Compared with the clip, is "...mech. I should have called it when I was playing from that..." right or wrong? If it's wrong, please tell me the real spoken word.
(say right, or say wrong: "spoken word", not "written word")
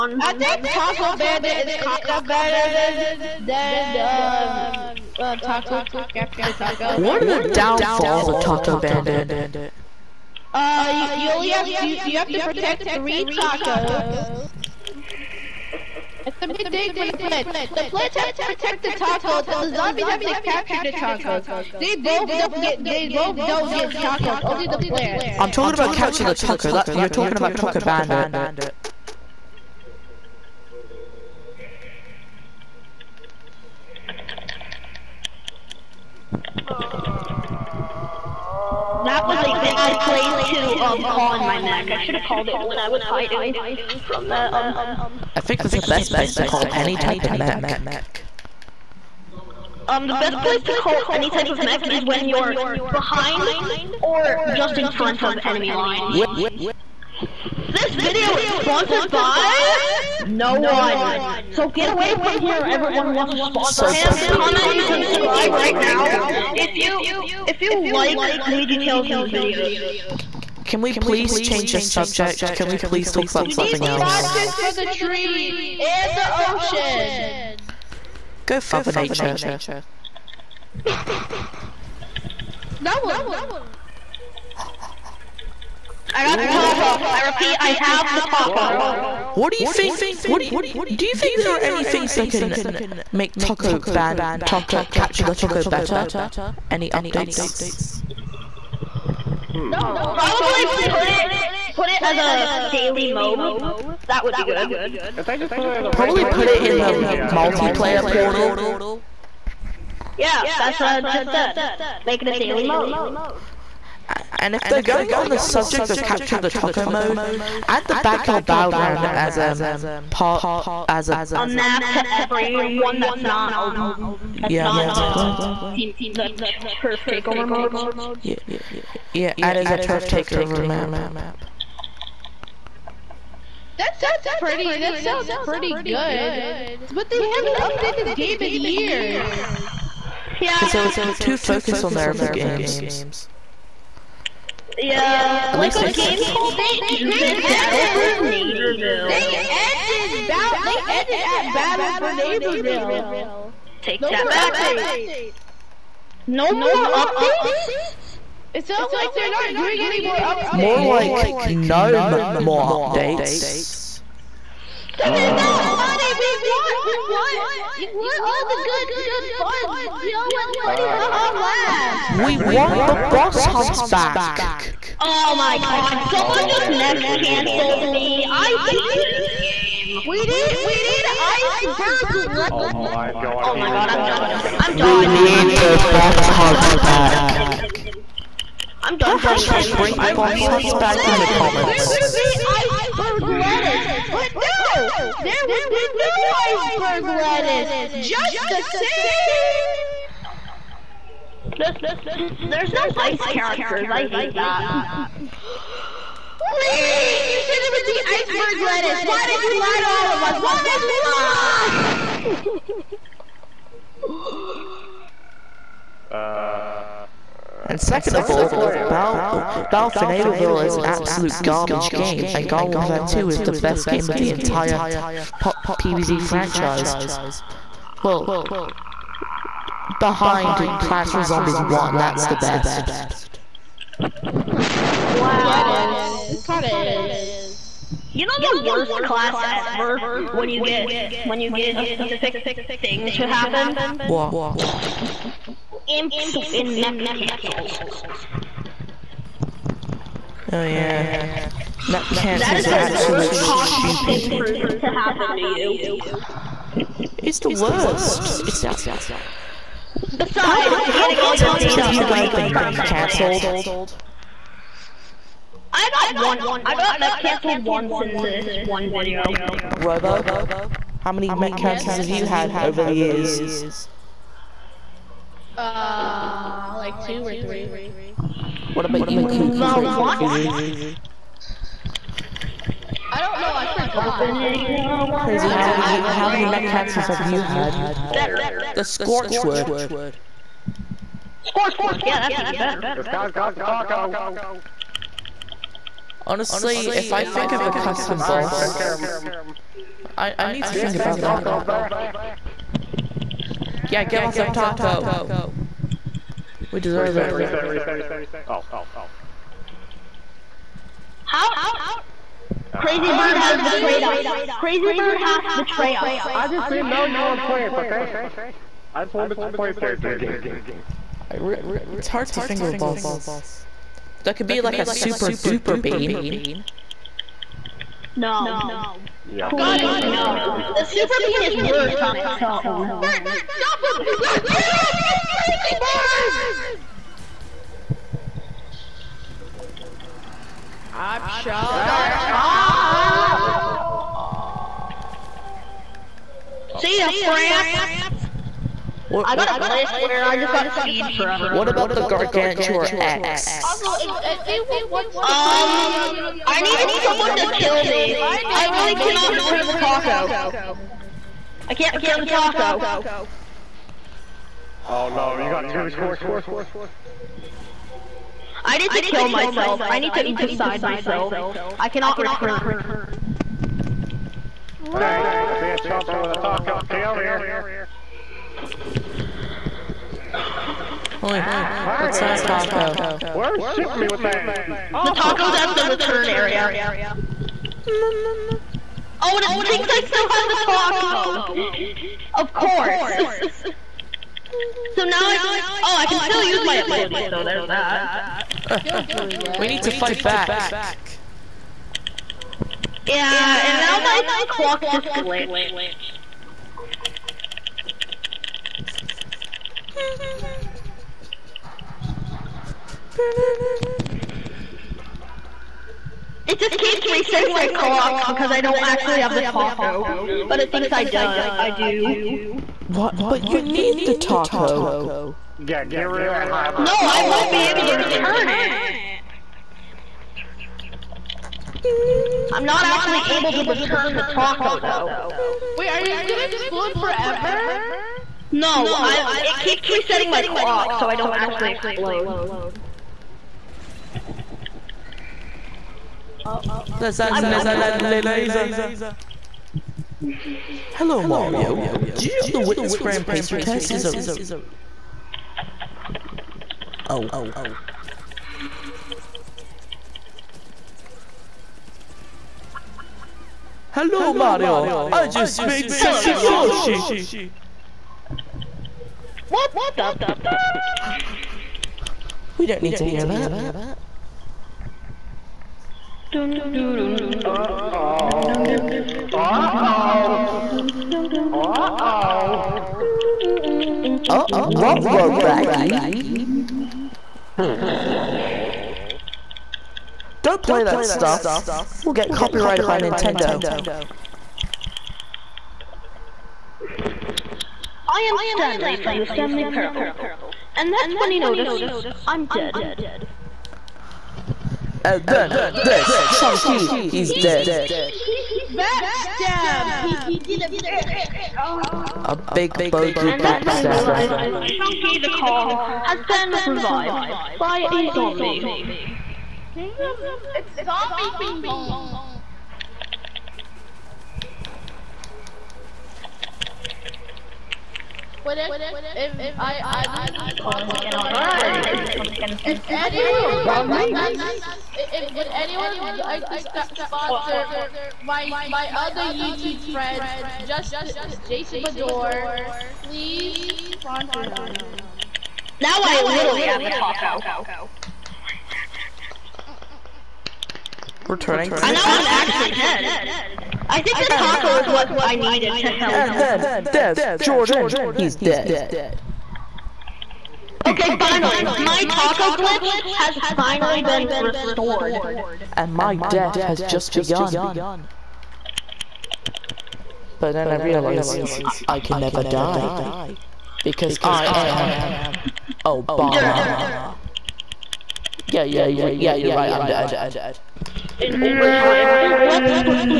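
wrong: "hiding", not "playing".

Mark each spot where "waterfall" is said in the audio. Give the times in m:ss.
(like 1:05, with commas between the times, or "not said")
not said.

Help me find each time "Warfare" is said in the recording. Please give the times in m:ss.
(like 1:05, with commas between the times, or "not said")
3:42.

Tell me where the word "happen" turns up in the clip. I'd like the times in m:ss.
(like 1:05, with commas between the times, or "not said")
4:03, 4:14.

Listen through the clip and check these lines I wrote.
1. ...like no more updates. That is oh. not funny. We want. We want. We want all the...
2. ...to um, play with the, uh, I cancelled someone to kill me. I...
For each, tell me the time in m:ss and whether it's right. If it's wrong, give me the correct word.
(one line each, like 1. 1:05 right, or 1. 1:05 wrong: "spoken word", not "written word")
1. 2:40 right
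2. 5:55 wrong: "needed", not "cancelled".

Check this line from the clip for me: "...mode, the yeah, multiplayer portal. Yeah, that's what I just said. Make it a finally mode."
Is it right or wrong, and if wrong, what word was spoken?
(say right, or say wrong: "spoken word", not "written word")
wrong: "daily", not "finally".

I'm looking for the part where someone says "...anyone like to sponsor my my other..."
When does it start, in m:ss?
8:55.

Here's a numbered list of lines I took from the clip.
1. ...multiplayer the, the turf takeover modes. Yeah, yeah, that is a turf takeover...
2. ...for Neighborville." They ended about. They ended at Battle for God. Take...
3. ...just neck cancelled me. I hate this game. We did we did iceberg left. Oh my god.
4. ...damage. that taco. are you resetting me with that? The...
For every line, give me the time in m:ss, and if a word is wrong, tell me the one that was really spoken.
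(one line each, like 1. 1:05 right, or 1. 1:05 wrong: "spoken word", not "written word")
1. 2:04 right
2. 2:28 wrong: "Neighborville", not "God"
3. 2:56 right
4. 6:22 wrong: "shooting", not "resetting".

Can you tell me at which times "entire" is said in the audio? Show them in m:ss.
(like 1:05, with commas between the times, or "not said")
3:44.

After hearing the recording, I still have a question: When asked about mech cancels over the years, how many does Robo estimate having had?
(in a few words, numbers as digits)
Two or three.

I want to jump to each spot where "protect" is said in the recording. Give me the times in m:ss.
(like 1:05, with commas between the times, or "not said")
0:12, 0:18.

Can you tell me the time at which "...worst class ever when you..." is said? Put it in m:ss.
3:58.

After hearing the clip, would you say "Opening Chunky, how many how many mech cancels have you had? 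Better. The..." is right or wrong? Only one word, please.
wrong.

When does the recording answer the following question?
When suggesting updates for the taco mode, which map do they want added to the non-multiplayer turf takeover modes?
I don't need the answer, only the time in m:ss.
1:57.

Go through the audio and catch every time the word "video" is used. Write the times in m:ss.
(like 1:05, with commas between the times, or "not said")
0:57, 1:09, 4:28.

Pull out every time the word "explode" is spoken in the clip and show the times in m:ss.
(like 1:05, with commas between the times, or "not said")
7:16, 7:21.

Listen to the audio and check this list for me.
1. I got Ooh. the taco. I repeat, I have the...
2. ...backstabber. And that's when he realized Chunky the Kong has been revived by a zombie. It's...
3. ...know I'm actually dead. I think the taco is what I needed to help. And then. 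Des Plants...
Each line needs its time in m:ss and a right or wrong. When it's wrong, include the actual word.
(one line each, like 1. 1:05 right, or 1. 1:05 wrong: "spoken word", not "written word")
1. 1:26 right
2. 8:33 right
3. 9:11 wrong: "Jordan", not "Plants".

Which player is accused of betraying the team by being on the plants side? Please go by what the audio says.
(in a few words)
Crazy Bird.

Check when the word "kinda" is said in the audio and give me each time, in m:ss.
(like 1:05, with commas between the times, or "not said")
0:01, 3:56.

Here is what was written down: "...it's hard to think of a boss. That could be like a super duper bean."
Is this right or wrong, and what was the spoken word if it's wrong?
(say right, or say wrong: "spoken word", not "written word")
right.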